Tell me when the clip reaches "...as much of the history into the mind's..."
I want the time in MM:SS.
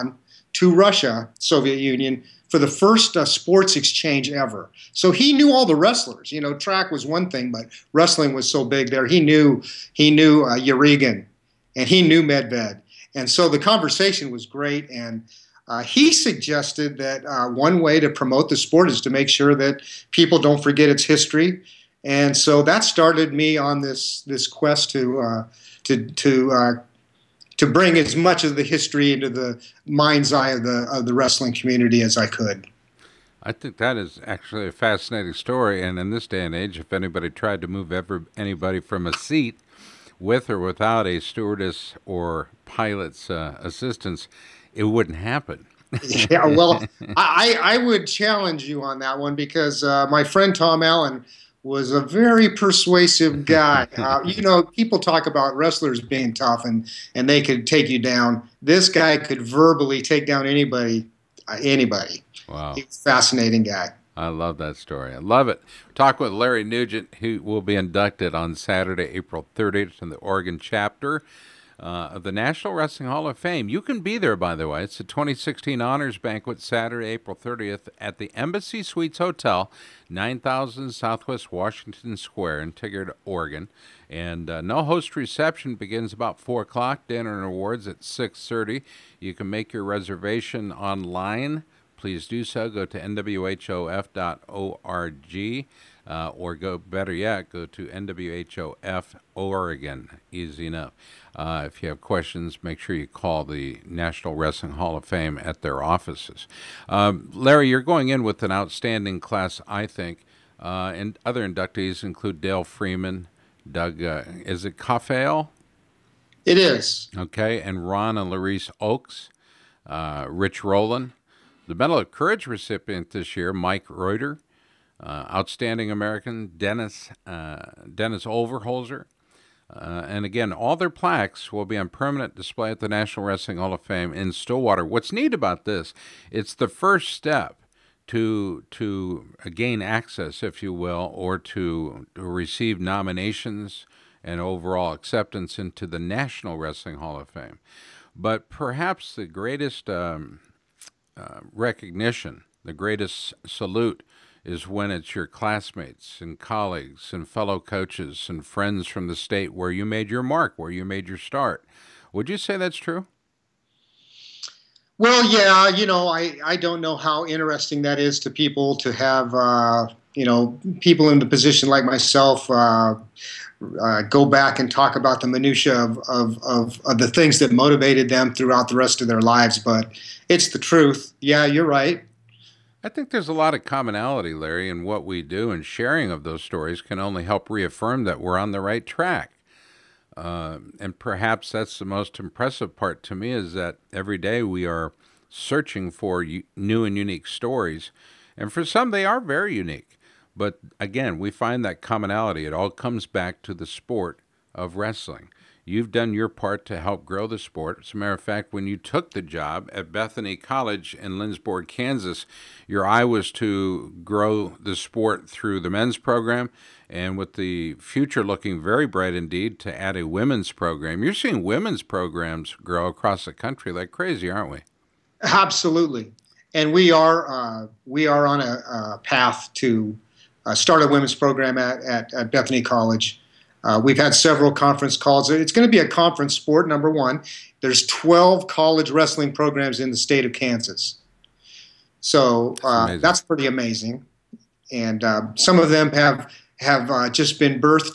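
00:27.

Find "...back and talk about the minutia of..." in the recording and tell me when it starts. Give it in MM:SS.
02:54.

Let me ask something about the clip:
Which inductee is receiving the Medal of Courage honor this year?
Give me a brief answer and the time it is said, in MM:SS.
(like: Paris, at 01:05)
Rich Roland, at 02:00.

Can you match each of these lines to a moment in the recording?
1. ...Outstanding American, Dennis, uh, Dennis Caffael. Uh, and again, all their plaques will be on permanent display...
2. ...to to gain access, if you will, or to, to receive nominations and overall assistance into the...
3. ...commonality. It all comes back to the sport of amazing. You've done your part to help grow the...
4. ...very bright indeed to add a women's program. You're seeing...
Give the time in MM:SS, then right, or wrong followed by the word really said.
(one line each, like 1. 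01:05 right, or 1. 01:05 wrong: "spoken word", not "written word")
1. 02:05 wrong: "Overholzer", not "Caffael"
2. 02:18 wrong: "acceptance", not "assistance"
3. 03:21 wrong: "wrestling", not "amazing"
4. 03:38 right.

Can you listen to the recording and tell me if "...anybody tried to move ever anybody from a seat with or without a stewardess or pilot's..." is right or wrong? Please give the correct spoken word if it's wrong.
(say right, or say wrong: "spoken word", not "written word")
right.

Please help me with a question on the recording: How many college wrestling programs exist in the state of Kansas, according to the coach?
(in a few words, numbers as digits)
12.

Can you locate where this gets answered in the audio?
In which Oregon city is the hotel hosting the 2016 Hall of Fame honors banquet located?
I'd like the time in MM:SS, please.
01:22.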